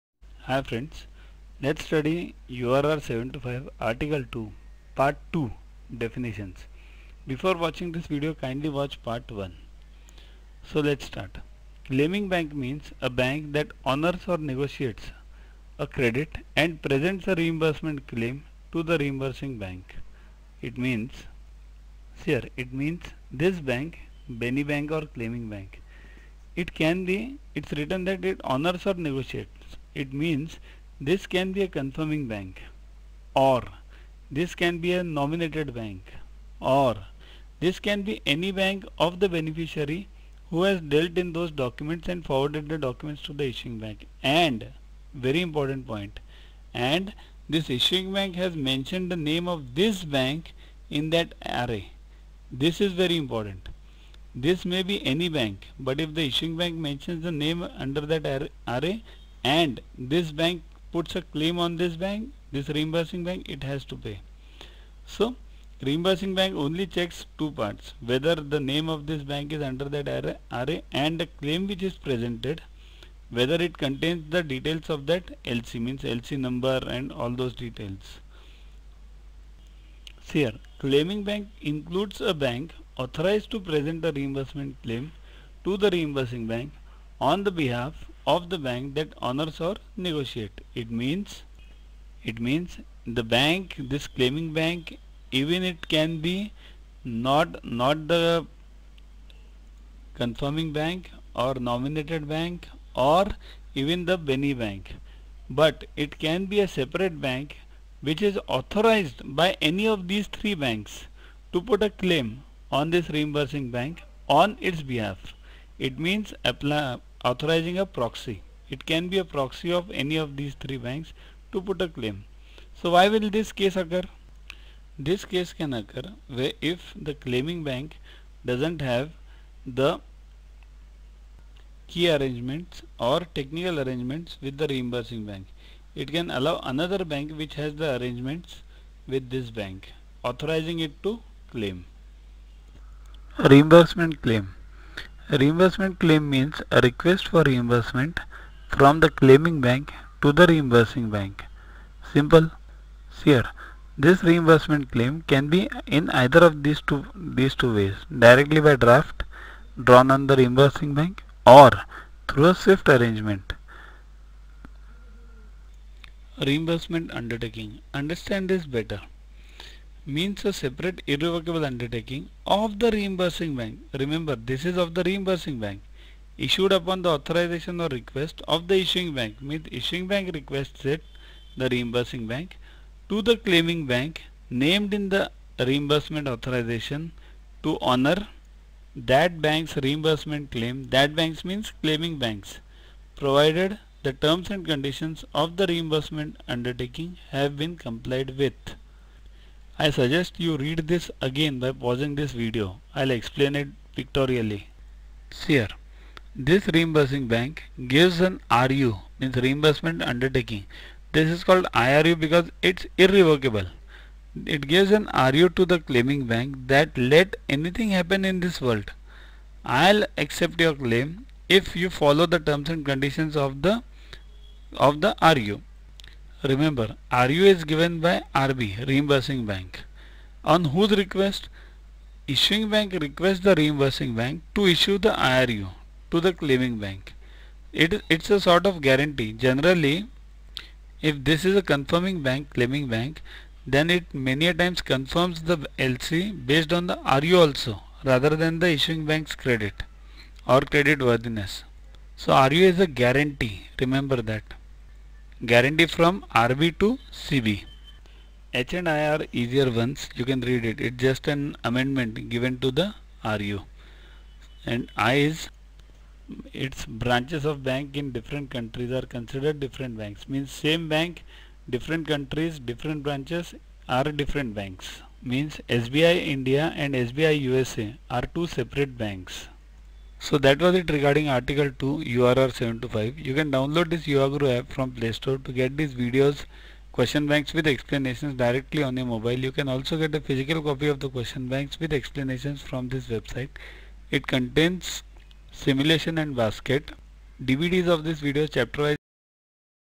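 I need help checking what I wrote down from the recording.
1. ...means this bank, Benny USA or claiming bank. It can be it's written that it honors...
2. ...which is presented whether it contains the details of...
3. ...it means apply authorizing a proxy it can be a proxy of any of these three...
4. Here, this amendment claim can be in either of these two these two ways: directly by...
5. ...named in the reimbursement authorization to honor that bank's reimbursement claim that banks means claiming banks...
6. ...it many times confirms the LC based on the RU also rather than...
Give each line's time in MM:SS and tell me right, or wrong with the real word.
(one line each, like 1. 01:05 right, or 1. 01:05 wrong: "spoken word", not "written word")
1. 00:22 wrong: "Bank", not "USA"
2. 01:11 right
3. 01:55 right
4. 02:33 wrong: "reimbursement", not "amendment"
5. 03:04 right
6. 04:03 right.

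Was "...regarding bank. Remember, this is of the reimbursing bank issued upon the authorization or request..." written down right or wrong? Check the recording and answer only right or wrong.
wrong.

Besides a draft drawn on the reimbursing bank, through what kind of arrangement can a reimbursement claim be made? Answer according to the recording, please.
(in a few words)
SWIFT arrangement.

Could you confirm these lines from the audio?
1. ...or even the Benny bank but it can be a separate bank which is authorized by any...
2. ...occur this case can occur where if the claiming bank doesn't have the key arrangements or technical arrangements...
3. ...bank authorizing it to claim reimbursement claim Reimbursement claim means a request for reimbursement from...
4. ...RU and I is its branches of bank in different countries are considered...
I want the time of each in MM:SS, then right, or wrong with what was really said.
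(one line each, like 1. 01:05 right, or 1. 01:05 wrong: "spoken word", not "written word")
1. 01:42 right
2. 02:03 right
3. 02:19 right
4. 04:23 right.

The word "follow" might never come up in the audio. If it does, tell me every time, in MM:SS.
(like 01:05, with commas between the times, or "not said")
03:41.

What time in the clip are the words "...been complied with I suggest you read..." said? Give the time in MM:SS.
03:17.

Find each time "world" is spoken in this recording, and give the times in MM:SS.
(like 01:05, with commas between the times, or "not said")
03:38.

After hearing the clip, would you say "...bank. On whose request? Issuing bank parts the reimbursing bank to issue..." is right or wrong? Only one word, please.
wrong.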